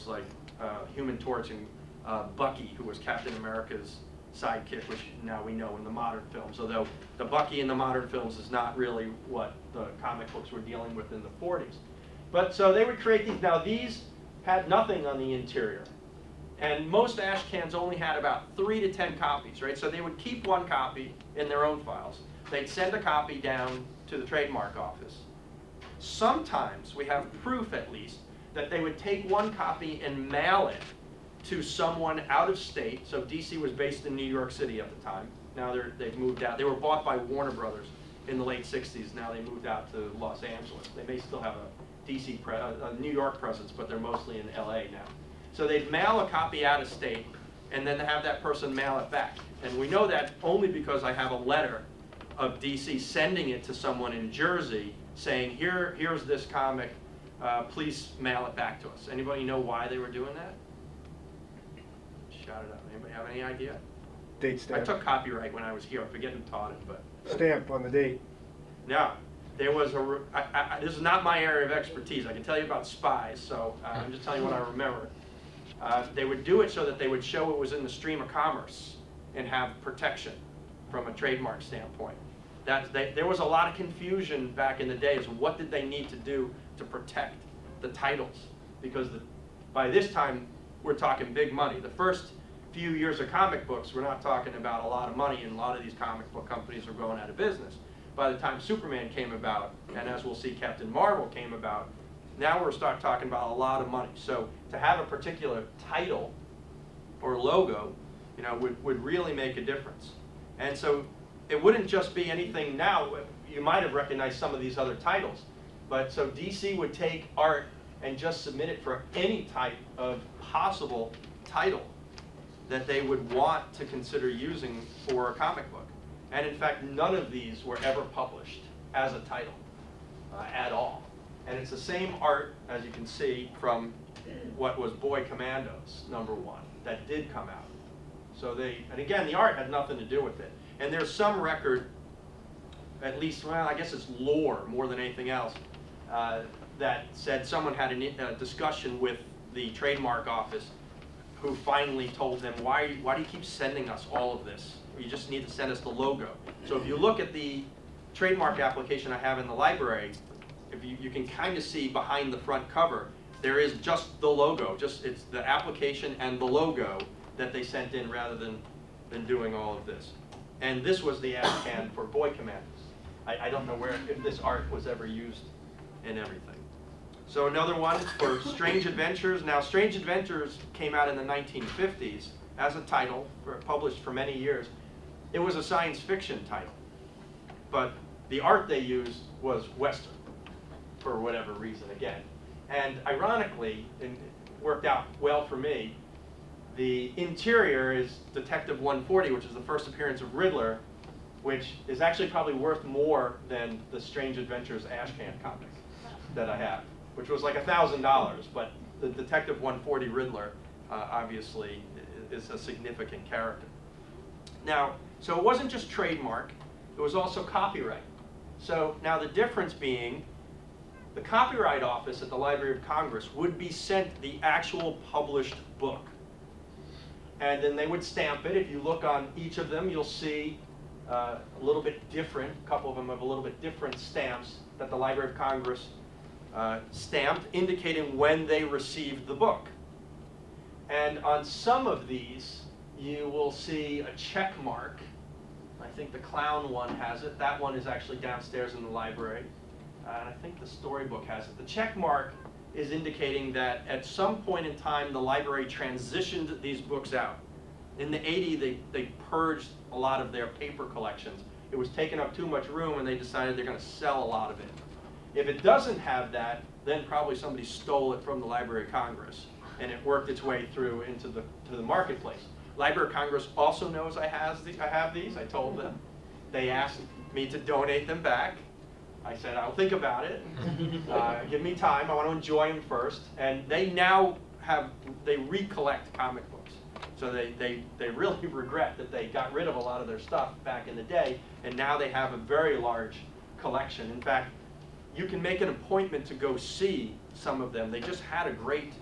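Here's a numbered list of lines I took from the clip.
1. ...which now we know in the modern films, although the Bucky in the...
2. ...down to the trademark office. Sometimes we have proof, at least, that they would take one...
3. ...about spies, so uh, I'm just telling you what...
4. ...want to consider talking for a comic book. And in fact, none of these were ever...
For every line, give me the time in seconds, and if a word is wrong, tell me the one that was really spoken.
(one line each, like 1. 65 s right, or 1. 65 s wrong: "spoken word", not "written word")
1. 4 s right
2. 23 s right
3. 72 s right
4. 123 s wrong: "using", not "talking".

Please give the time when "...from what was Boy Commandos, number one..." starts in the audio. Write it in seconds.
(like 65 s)
133 s.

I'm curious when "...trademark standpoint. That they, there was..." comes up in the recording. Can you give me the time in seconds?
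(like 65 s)
81 s.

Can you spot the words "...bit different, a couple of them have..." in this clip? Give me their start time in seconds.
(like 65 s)
231 s.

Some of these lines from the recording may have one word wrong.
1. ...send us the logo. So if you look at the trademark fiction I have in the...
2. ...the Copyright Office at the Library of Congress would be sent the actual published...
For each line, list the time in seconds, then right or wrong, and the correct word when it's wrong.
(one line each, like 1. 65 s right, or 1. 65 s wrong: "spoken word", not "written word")
1. 155 s wrong: "application", not "fiction"
2. 221 s right.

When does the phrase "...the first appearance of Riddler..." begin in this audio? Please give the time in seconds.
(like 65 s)
199 s.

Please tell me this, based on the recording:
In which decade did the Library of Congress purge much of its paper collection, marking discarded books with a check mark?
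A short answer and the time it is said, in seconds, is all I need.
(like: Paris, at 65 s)
1980s, at 258 s.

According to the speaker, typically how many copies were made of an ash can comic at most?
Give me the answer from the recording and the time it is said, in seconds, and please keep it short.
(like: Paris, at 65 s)
3 to 10, at 18 s.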